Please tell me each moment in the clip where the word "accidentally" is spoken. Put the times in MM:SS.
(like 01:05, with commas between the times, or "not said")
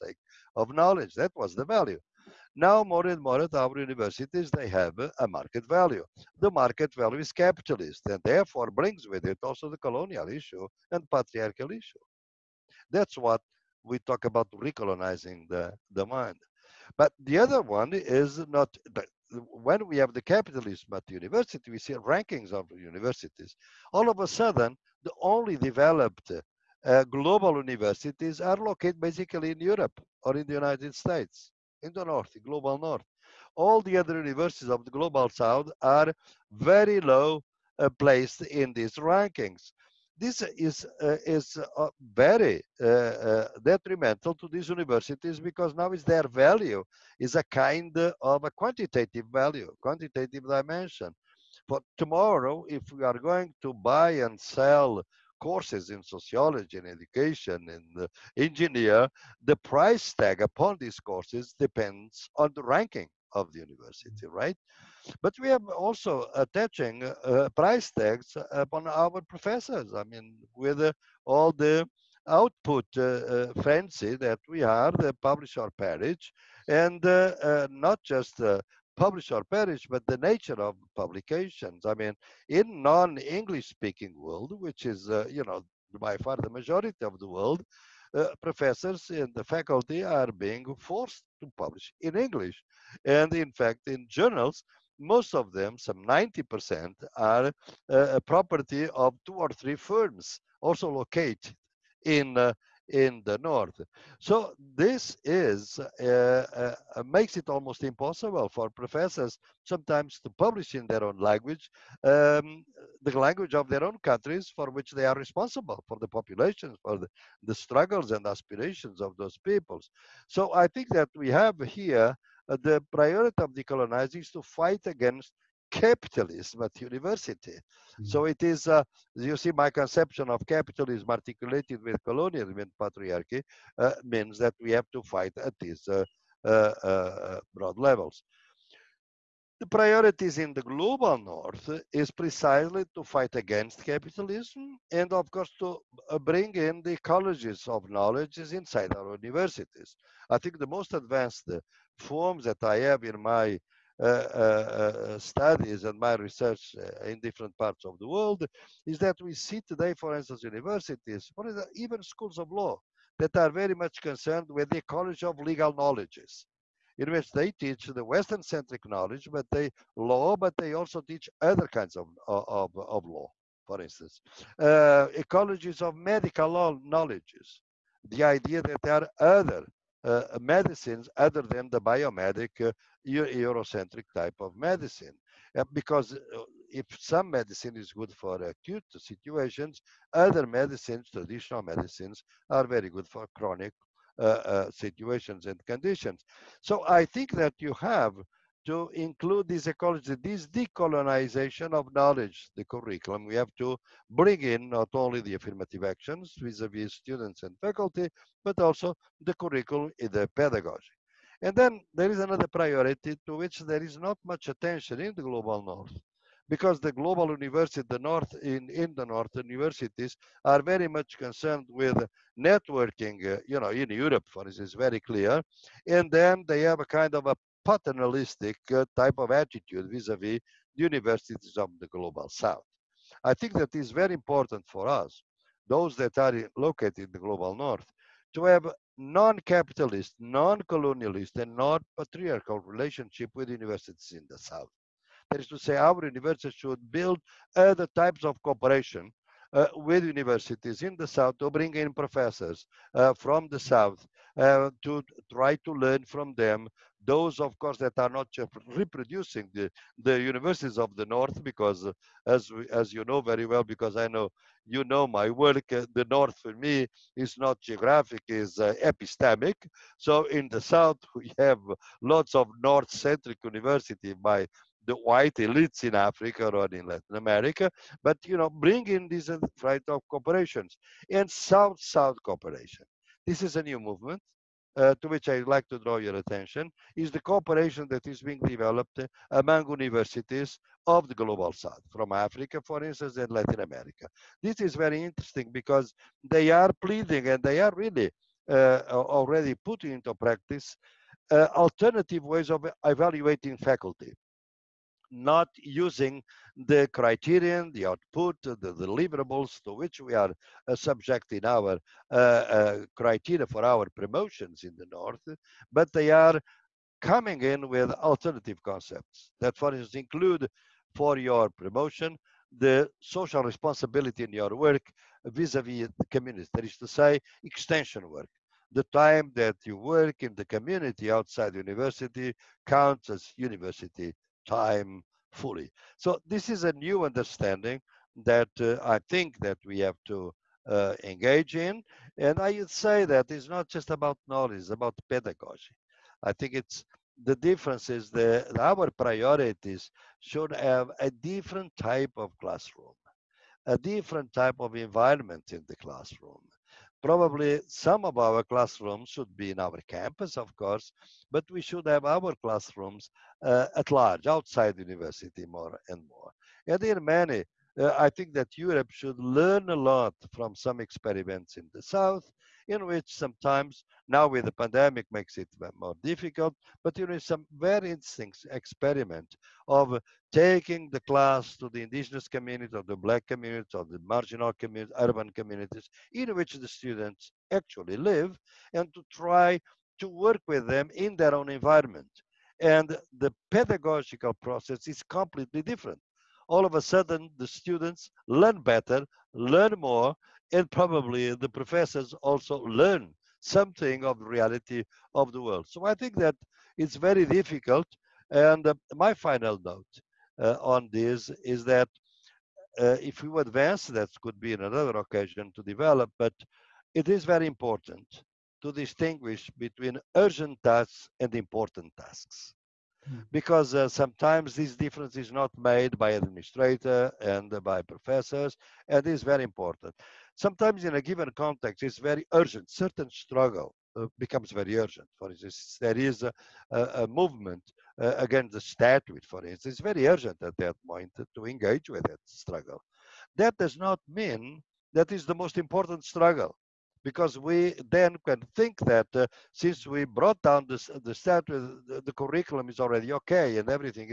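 not said.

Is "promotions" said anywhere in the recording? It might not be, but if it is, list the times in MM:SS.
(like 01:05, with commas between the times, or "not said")
05:13, 05:21.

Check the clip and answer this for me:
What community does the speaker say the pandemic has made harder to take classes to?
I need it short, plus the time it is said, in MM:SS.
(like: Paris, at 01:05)
indigenous community, at 06:21.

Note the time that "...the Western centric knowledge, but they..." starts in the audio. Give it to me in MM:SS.
02:47.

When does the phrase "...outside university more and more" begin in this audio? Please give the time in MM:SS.
06:04.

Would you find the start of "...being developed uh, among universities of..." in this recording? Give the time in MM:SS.
04:48.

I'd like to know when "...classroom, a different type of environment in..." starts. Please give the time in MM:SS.
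05:52.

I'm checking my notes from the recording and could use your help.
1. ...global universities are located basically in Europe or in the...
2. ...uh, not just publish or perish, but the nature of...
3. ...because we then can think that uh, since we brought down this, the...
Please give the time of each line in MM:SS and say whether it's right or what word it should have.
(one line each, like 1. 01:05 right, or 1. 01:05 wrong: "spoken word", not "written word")
1. 00:27 right
2. 01:17 right
3. 07:27 right.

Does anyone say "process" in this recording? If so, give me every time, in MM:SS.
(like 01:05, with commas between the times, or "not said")
06:34.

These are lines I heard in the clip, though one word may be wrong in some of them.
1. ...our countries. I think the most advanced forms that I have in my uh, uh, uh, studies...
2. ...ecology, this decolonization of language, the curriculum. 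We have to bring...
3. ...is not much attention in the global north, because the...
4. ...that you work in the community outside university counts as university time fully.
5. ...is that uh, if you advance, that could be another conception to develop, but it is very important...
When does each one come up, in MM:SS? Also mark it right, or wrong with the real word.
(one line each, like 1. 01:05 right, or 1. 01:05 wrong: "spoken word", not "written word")
1. 02:28 wrong: "universities", not "countries"
2. 03:19 wrong: "knowledge", not "language"
3. 03:33 right
4. 05:29 right
5. 06:51 wrong: "occasion", not "conception".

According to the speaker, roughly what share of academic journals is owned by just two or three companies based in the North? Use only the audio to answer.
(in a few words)
90%.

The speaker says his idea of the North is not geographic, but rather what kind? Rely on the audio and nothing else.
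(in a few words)
epistemic.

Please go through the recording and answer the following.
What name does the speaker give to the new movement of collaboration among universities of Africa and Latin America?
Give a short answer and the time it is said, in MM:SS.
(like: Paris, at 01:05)
South-South cooperation, at 04:41.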